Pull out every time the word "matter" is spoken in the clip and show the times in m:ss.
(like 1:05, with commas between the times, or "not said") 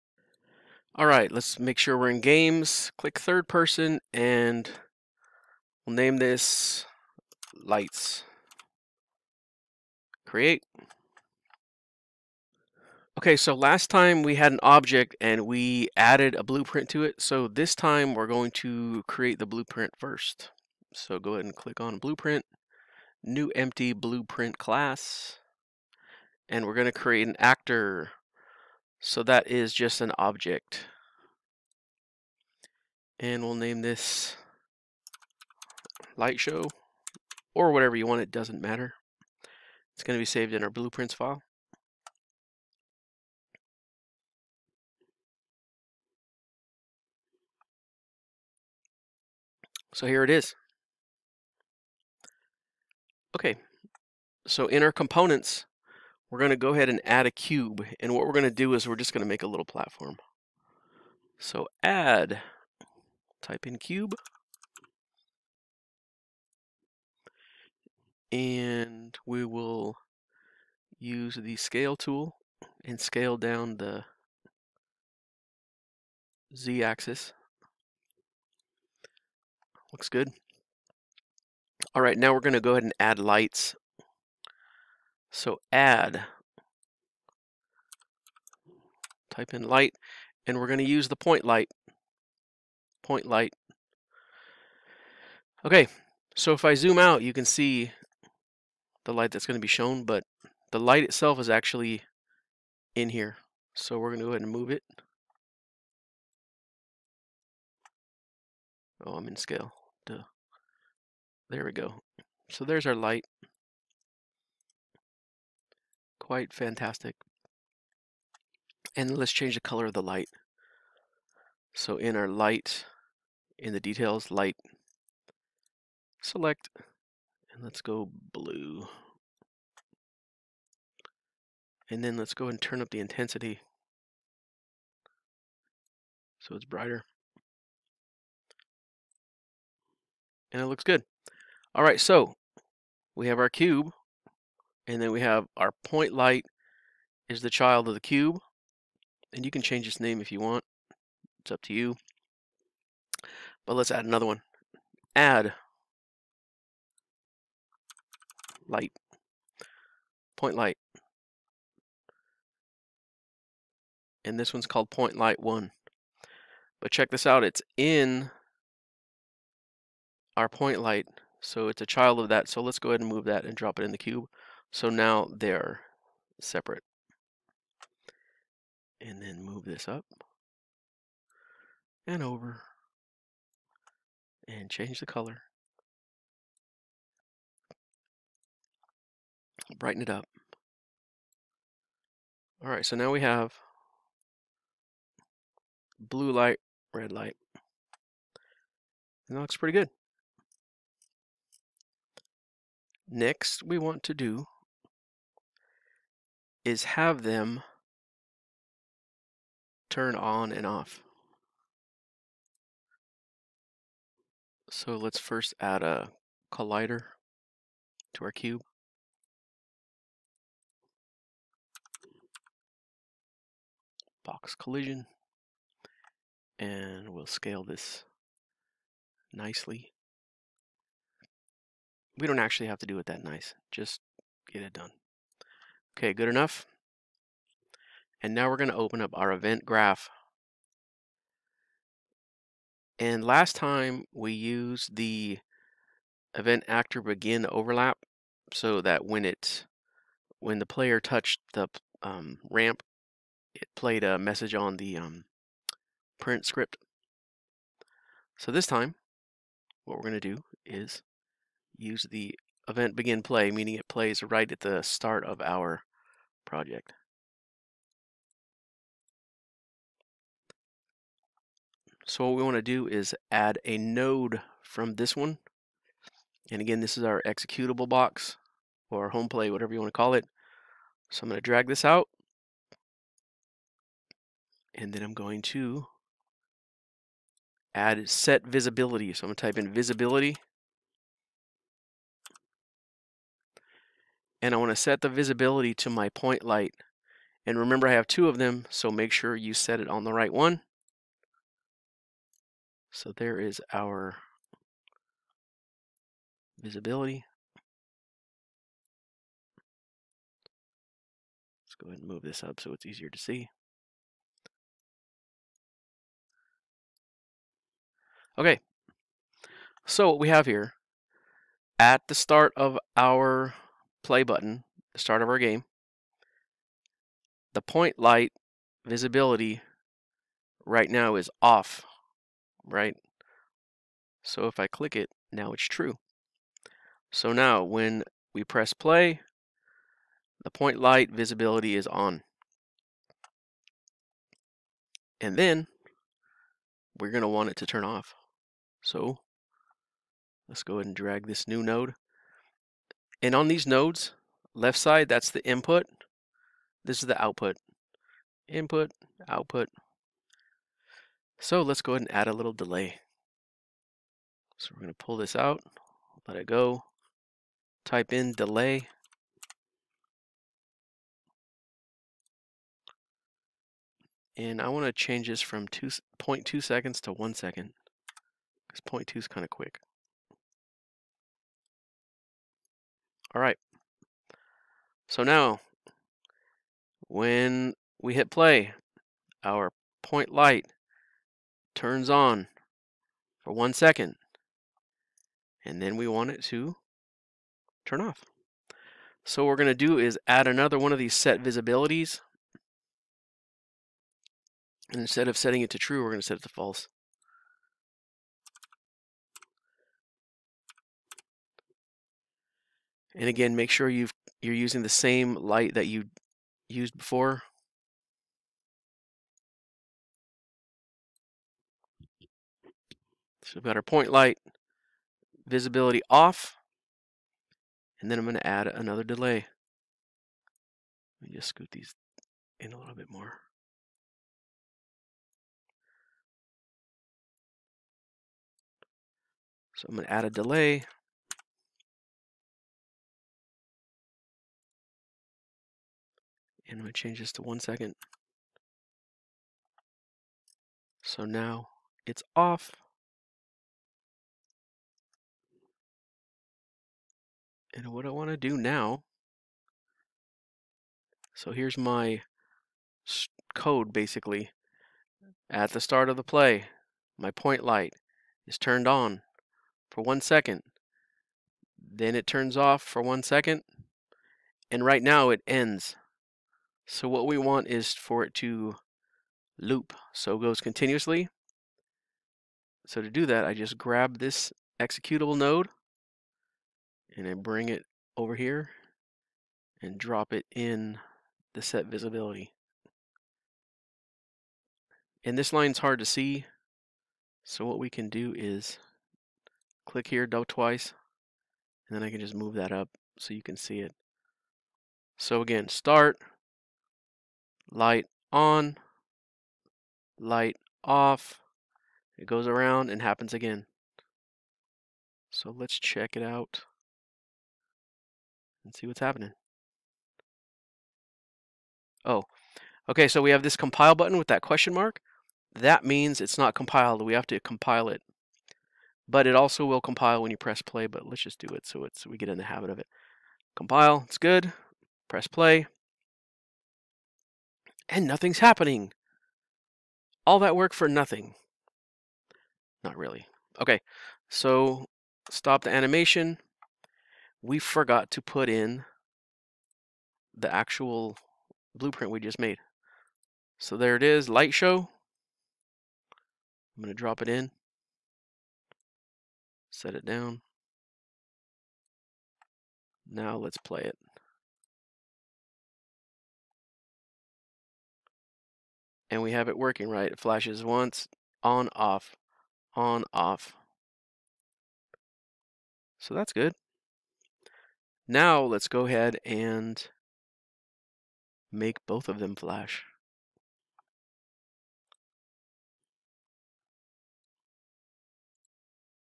0:38.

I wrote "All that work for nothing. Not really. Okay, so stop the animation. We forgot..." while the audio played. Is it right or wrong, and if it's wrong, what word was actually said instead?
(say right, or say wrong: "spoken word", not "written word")
right.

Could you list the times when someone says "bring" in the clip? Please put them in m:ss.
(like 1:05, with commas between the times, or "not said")
8:07.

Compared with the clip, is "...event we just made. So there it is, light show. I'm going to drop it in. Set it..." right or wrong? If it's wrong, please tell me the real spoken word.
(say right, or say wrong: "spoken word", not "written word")
wrong: "blueprint", not "event".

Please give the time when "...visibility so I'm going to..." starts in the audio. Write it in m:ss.
4:48.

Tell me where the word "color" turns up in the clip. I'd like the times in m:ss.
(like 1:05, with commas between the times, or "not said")
1:59, 3:05.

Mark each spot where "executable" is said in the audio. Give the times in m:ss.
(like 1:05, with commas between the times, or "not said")
4:37, 8:04.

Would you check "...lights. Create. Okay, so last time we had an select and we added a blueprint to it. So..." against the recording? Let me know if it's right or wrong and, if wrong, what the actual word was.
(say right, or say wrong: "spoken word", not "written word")
wrong: "object", not "select".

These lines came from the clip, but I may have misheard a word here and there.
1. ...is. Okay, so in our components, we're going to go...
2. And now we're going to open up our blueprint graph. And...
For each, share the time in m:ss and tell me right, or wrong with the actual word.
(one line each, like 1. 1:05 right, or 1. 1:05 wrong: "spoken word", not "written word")
1. 0:50 right
2. 3:58 wrong: "event", not "blueprint".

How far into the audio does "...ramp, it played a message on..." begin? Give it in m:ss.
4:12.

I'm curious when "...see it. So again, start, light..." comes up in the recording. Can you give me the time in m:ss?
8:23.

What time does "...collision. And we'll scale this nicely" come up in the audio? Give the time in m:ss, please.
3:44.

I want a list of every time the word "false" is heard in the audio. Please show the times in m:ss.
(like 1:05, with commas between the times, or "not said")
6:46.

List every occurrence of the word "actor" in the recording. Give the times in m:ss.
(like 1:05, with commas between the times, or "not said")
0:27, 4:06.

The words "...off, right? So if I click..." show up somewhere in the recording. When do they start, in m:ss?
5:31.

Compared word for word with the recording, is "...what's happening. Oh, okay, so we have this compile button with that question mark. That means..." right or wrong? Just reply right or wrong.
right.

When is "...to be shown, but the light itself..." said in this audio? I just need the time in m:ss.
1:39.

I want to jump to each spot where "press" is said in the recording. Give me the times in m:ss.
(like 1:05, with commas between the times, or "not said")
5:38, 8:50, 8:55.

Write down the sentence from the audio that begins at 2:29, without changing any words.
And you can change its name if you want.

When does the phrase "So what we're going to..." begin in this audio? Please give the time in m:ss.
6:39.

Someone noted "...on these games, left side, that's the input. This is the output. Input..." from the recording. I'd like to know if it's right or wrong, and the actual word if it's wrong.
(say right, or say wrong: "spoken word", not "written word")
wrong: "nodes", not "games".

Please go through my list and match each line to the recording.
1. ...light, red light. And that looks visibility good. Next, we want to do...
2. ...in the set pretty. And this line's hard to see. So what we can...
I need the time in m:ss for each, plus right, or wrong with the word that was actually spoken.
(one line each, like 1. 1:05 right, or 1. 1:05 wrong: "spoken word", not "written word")
1. 3:16 wrong: "pretty", not "visibility"
2. 8:10 wrong: "visibility", not "pretty".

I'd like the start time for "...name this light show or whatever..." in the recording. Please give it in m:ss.
0:33.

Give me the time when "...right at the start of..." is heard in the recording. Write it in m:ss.
4:24.